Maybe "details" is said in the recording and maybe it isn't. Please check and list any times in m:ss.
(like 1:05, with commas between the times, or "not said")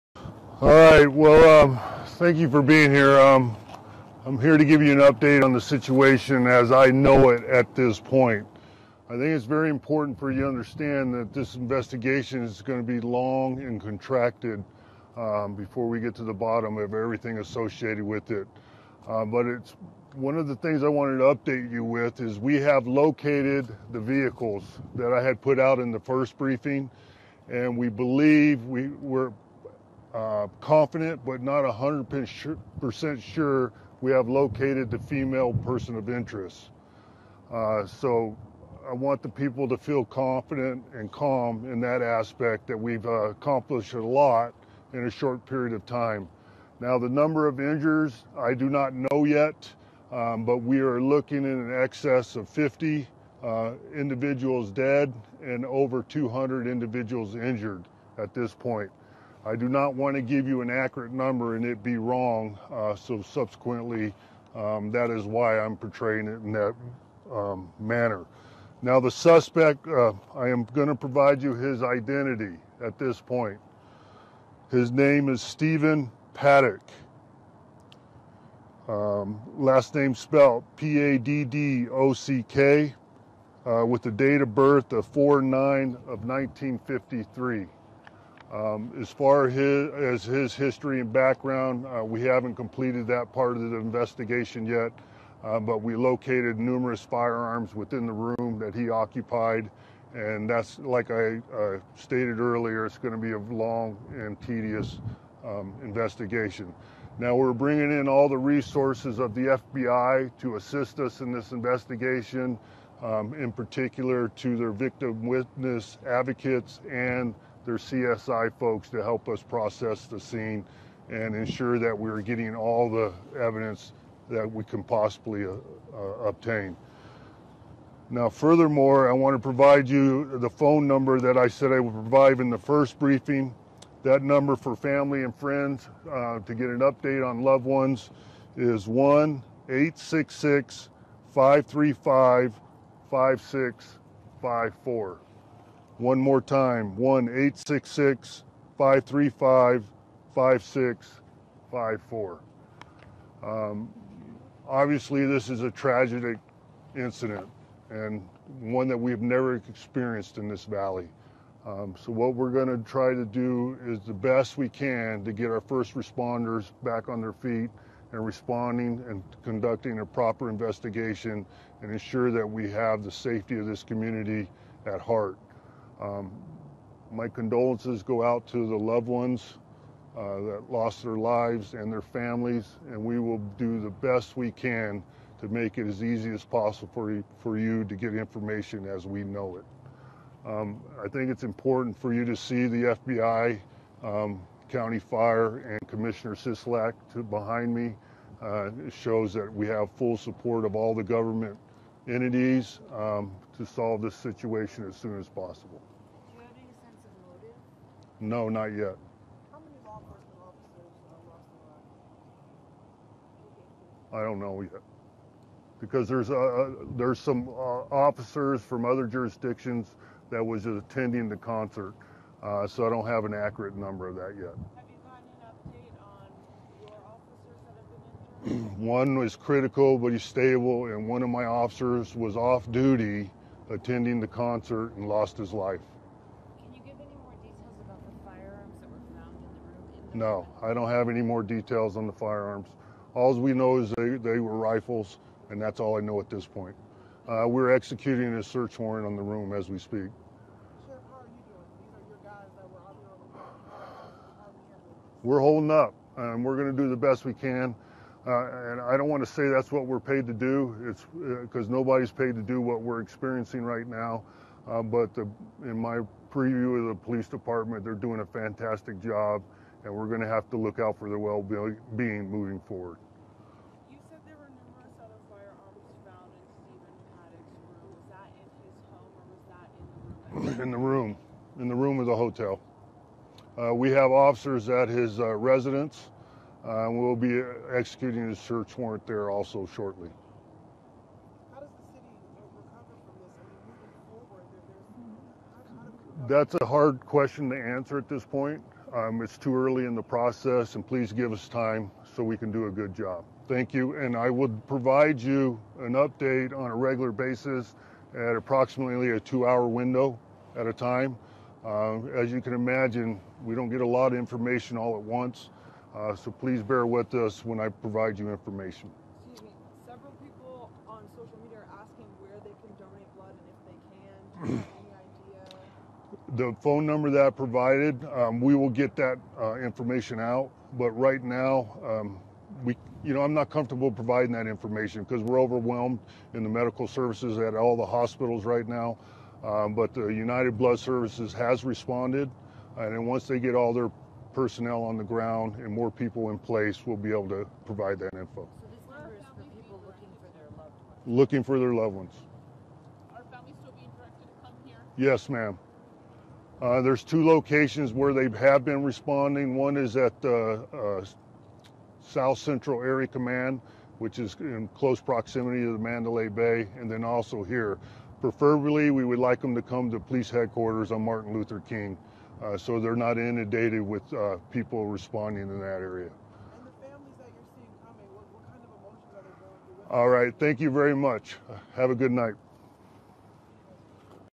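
3:57, 4:01.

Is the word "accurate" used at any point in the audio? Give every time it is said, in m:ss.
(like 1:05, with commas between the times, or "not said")
1:00, 3:43.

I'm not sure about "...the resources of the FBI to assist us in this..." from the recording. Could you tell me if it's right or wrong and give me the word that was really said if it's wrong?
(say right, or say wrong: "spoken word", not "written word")
right.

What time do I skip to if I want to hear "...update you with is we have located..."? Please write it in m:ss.
0:21.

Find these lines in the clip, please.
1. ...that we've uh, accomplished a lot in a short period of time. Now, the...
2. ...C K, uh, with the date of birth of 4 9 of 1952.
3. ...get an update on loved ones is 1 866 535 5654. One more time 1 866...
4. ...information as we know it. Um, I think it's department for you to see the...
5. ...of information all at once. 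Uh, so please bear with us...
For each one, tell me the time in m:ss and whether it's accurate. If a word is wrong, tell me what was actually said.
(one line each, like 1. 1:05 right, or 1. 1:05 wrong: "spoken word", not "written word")
1. 0:42 right
2. 1:22 wrong: "1953", not "1952"
3. 2:16 right
4. 3:08 wrong: "important", not "department"
5. 5:14 right.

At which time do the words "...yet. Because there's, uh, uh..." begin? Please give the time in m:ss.
3:34.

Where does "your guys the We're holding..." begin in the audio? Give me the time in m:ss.
4:12.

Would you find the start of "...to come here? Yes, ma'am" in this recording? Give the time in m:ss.
5:54.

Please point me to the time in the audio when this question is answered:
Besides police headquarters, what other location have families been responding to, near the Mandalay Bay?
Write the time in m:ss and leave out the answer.
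6:02.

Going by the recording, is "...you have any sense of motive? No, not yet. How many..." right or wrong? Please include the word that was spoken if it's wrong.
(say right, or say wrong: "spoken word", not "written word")
right.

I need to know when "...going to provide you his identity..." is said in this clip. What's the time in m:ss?
1:10.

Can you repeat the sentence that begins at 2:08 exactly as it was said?
Now, furthermore, I want to provide you the phone number that I said I would provide in the first briefing.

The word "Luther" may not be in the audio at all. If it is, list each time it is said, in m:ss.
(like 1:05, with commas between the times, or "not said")
6:11.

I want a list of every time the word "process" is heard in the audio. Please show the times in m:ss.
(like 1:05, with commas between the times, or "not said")
1:59, 5:00.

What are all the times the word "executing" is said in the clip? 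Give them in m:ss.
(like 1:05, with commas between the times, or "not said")
4:07, 4:47.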